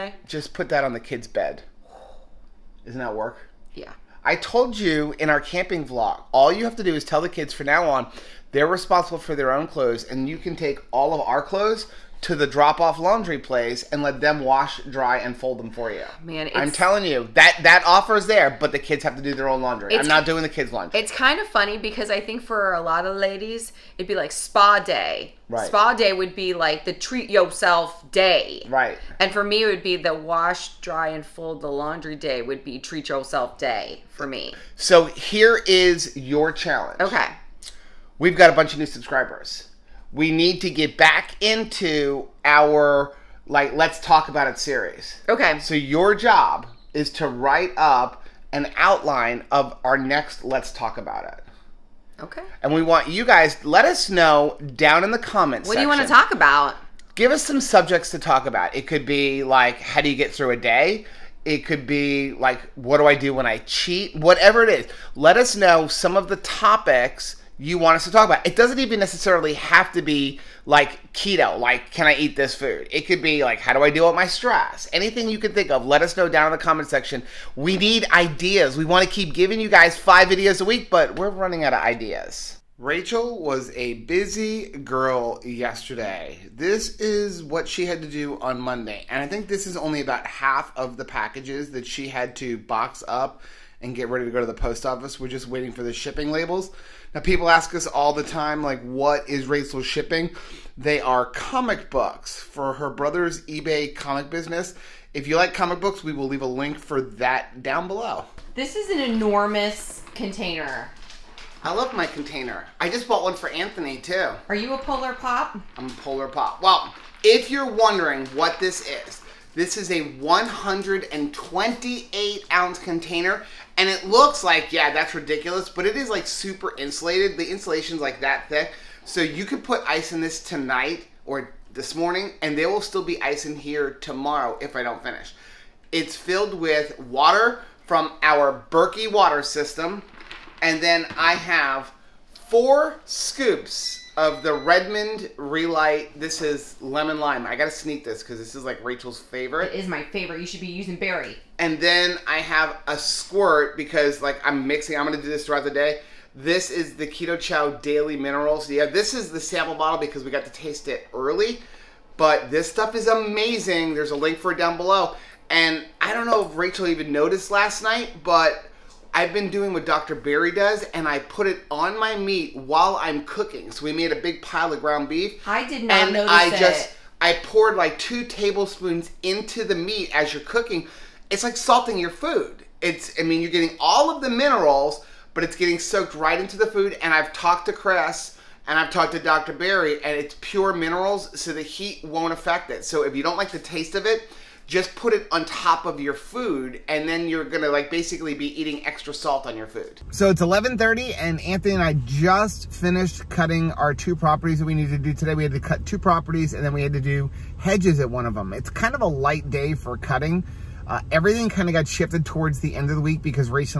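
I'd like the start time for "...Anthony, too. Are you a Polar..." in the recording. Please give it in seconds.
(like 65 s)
113 s.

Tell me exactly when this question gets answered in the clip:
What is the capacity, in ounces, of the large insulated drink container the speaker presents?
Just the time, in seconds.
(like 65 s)
120 s.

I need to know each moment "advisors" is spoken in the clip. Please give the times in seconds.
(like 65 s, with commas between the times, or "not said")
not said.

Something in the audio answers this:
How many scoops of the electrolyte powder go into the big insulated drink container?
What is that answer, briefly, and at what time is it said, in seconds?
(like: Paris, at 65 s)
4, at 142 s.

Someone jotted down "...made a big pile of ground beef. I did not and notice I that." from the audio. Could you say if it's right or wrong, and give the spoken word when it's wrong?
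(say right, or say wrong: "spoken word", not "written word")
right.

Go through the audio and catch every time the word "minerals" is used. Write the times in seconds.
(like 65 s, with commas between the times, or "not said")
158 s, 184 s, 190 s.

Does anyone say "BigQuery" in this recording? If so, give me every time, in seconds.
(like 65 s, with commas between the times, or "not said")
not said.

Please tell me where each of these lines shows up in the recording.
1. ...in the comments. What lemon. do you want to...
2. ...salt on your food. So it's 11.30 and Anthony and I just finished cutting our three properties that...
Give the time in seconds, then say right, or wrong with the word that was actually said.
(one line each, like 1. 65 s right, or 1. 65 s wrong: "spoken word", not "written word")
1. 55 s wrong: "section", not "lemon"
2. 199 s wrong: "two", not "three".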